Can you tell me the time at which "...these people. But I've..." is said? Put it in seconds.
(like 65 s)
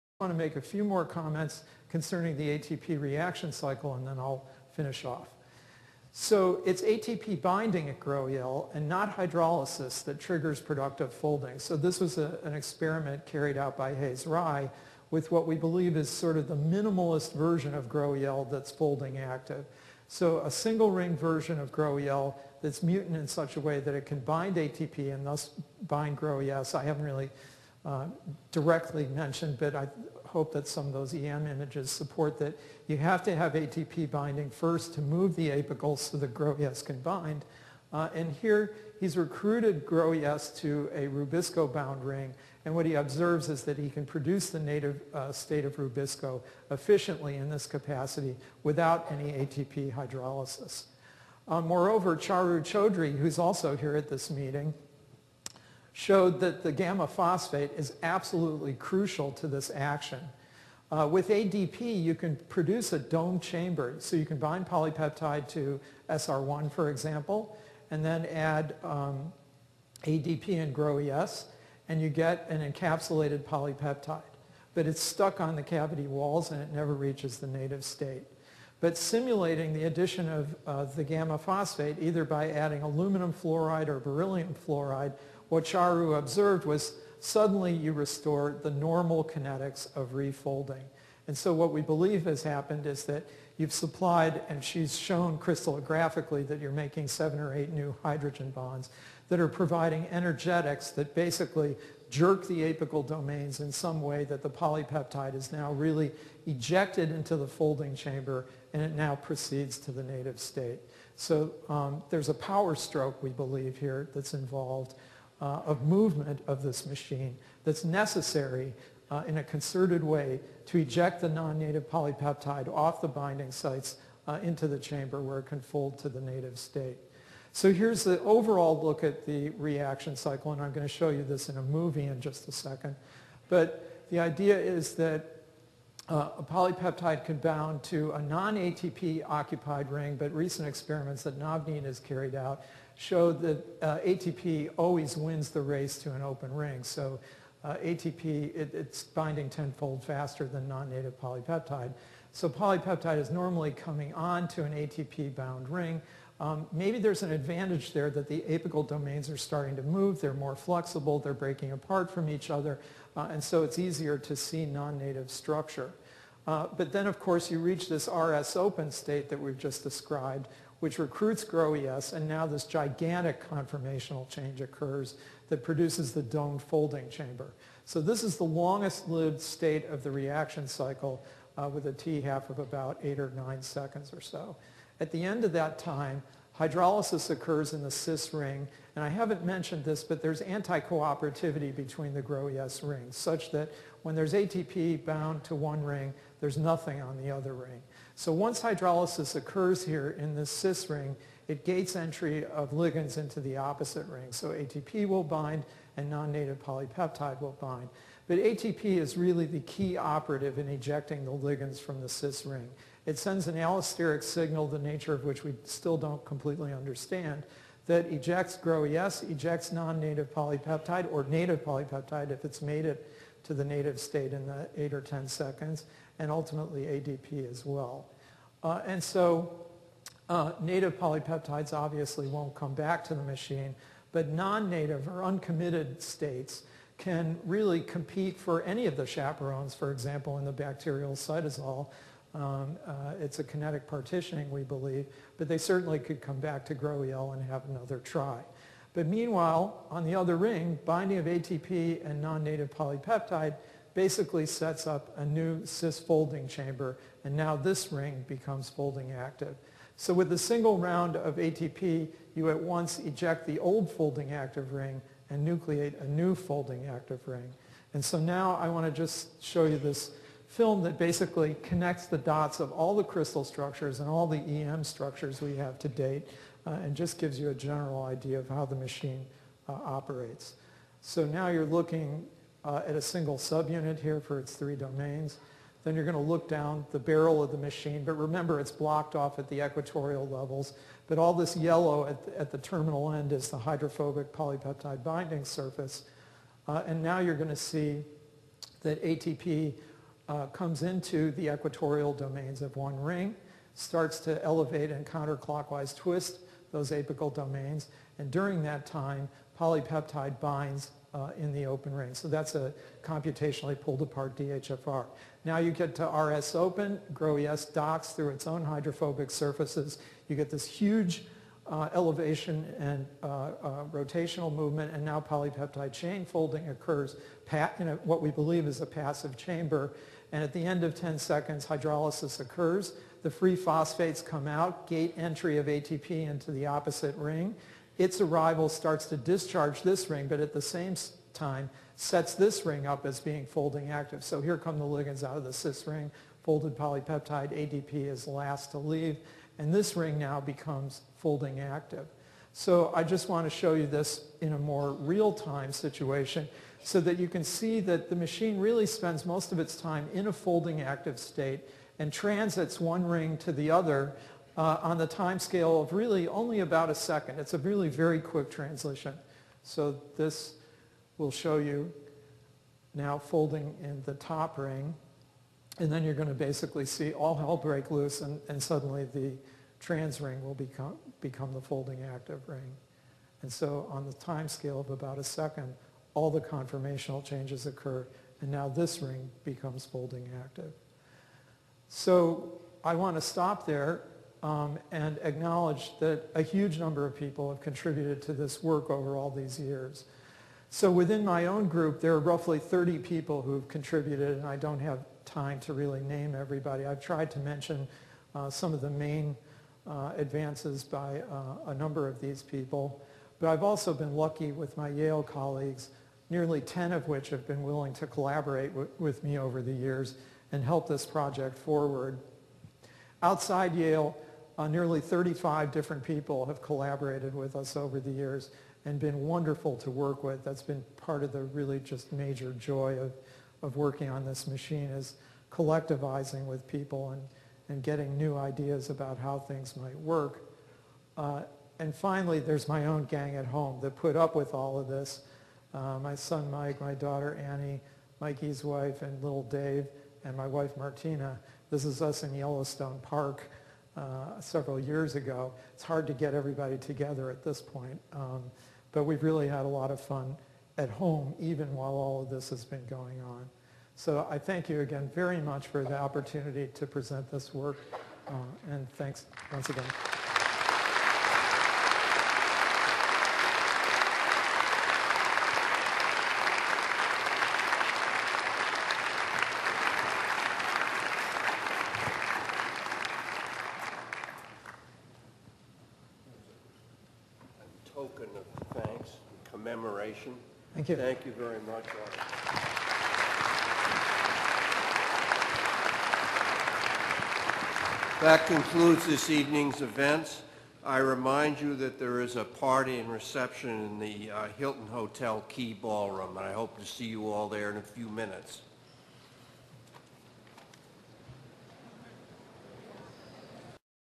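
412 s.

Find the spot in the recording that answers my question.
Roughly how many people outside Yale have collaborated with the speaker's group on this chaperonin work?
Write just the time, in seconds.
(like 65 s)
424 s.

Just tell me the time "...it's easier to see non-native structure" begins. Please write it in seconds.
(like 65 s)
163 s.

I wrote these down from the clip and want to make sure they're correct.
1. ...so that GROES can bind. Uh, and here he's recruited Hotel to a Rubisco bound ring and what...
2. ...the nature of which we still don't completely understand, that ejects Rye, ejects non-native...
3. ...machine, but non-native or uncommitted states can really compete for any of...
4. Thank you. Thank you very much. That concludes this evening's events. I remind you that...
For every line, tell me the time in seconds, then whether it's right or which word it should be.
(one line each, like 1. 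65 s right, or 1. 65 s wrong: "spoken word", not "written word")
1. 35 s wrong: "GROES", not "Hotel"
2. 214 s wrong: "GROES", not "Rye"
3. 233 s right
4. 490 s right.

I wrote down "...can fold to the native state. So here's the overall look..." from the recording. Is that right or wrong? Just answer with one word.
right.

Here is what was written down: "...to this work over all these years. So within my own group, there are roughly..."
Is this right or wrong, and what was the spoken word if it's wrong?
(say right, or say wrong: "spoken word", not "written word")
right.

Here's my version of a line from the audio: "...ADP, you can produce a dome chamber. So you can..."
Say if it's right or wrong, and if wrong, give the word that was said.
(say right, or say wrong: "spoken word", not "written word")
right.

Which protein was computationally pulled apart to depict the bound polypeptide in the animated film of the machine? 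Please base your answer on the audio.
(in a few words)
DHFR.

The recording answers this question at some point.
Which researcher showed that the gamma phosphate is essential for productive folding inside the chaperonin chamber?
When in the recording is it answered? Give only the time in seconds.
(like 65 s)
52 s.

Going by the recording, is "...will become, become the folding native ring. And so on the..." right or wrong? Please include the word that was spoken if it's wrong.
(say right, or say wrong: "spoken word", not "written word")
wrong: "active", not "native".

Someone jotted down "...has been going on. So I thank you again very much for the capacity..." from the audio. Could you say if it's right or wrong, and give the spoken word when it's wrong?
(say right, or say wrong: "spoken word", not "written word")
wrong: "opportunity", not "capacity".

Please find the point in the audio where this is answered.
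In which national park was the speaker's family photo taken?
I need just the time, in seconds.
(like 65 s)
452 s.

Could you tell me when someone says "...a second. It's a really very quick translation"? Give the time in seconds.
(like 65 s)
366 s.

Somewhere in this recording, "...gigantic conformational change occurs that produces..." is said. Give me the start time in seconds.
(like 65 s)
172 s.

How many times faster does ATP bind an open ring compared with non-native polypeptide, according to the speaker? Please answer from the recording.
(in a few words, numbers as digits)
10-fold.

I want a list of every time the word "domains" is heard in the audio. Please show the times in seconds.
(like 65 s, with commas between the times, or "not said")
103 s, 158 s, 284 s, 302 s, 307 s.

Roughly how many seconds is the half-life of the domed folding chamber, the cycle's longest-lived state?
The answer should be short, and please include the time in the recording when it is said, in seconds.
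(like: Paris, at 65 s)
8 or 9 seconds, at 183 s.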